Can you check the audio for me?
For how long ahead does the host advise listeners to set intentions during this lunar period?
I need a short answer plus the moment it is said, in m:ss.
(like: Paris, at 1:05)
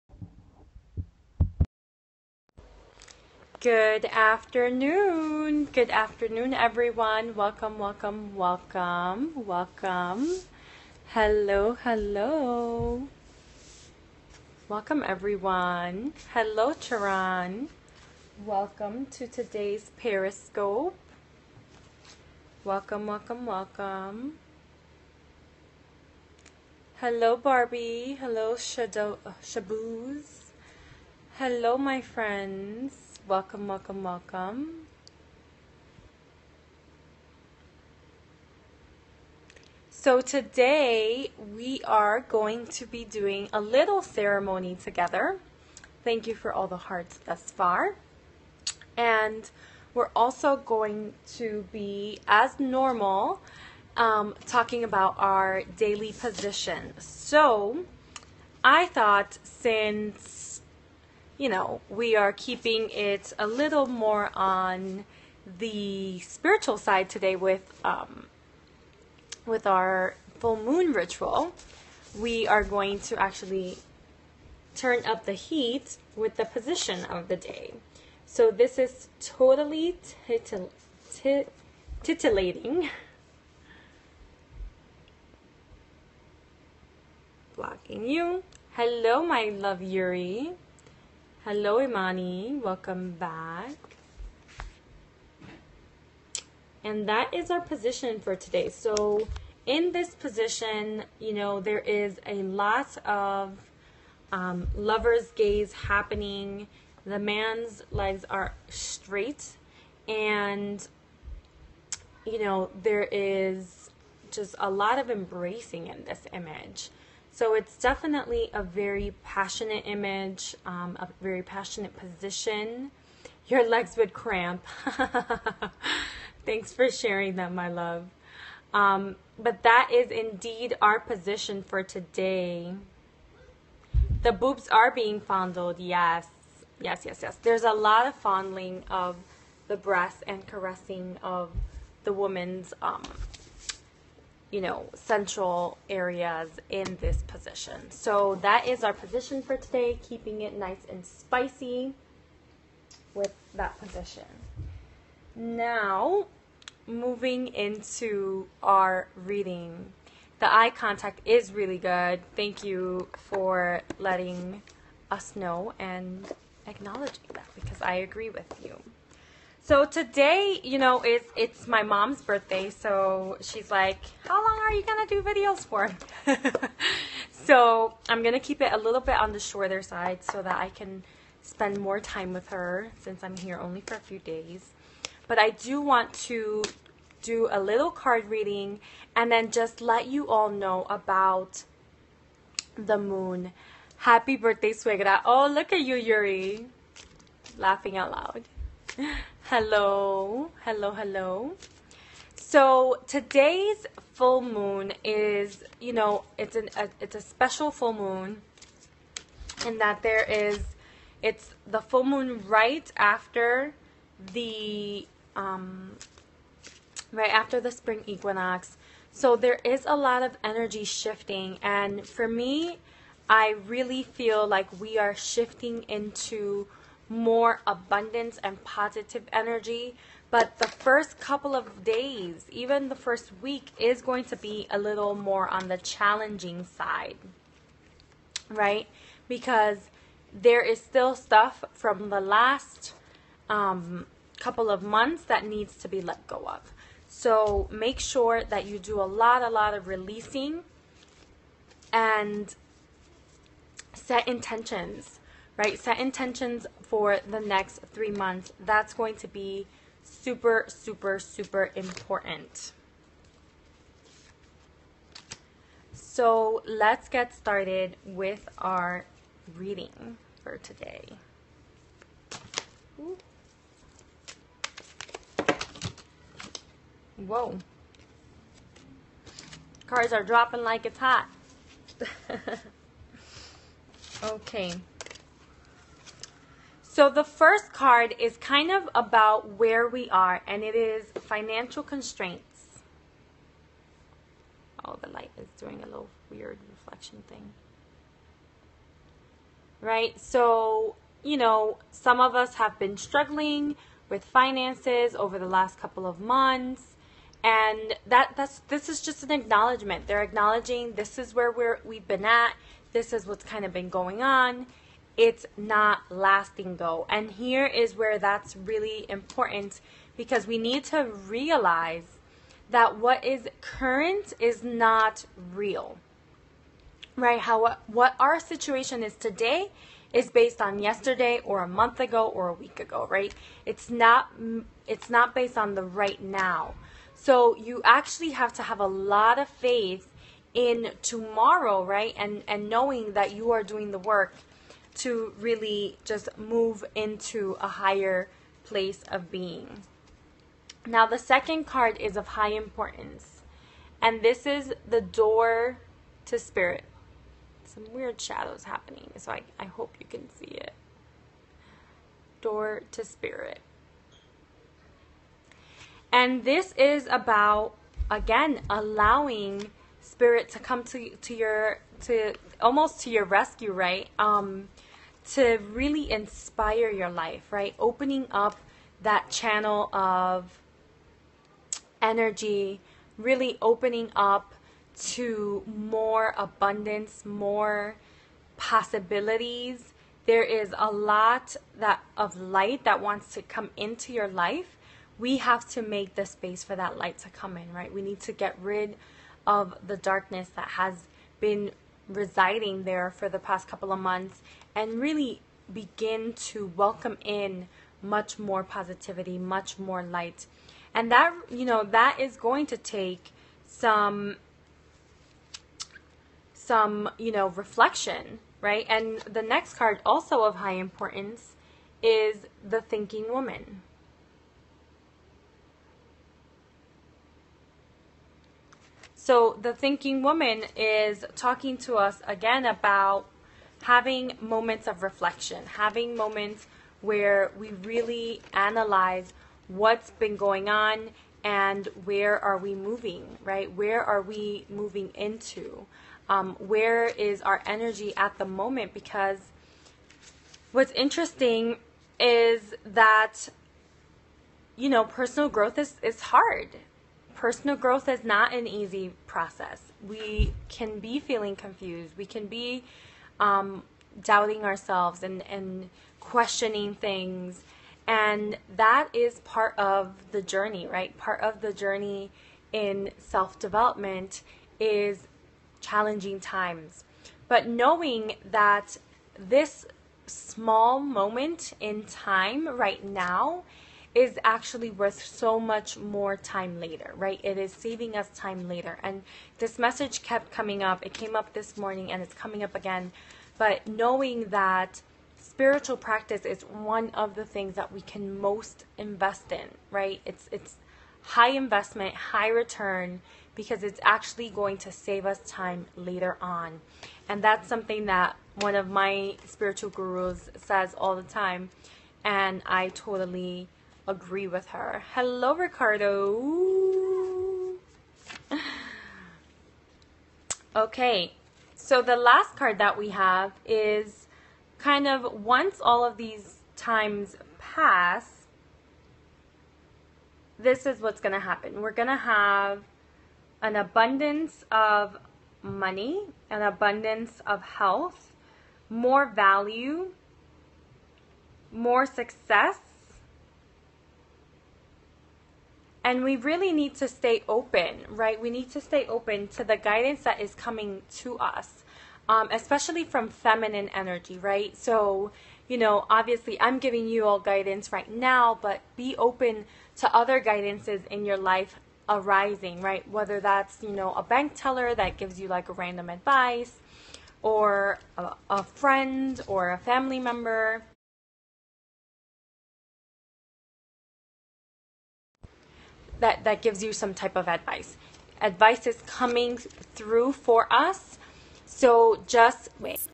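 3 months, at 4:17.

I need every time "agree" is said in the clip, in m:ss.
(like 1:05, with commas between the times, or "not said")
2:47, 8:34.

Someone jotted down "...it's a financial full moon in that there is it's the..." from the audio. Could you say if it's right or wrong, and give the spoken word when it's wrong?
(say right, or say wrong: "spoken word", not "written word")
wrong: "special", not "financial".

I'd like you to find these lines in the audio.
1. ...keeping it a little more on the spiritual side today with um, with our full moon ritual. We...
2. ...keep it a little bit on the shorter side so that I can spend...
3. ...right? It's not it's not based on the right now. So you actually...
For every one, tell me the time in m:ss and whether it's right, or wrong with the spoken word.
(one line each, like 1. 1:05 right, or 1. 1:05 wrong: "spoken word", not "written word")
1. 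1:02 right
2. 2:58 right
3. 5:33 right.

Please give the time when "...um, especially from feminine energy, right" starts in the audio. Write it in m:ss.
9:12.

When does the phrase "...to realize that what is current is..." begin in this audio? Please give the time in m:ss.
5:20.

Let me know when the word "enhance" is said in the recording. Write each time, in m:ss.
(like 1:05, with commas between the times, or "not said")
not said.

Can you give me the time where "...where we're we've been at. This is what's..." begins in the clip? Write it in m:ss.
5:11.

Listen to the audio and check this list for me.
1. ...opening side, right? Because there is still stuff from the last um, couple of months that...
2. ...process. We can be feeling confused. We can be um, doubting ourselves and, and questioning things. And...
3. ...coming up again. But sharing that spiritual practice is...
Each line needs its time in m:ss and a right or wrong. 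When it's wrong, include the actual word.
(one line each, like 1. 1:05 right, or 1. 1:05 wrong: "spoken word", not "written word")
1. 3:55 wrong: "challenging", not "opening"
2. 7:39 right
3. 8:12 wrong: "knowing", not "sharing".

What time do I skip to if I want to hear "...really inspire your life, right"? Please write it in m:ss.
6:15.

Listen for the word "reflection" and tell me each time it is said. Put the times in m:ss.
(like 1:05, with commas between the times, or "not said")
4:56, 6:57, 7:15.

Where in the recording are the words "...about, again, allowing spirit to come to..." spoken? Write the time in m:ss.
6:07.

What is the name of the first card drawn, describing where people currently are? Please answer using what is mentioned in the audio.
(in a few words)
Financial constraints.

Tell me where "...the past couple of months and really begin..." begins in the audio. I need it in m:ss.
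6:43.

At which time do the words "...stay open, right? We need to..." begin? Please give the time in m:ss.
9:07.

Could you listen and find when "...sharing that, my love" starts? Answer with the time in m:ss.
2:06.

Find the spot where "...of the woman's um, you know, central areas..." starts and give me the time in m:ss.
2:21.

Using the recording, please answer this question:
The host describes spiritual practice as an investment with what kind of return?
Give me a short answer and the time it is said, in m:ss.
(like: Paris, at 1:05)
High return, at 8:22.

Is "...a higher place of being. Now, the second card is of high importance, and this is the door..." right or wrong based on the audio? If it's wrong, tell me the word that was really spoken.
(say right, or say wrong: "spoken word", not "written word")
right.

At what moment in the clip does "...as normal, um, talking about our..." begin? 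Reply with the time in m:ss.
0:52.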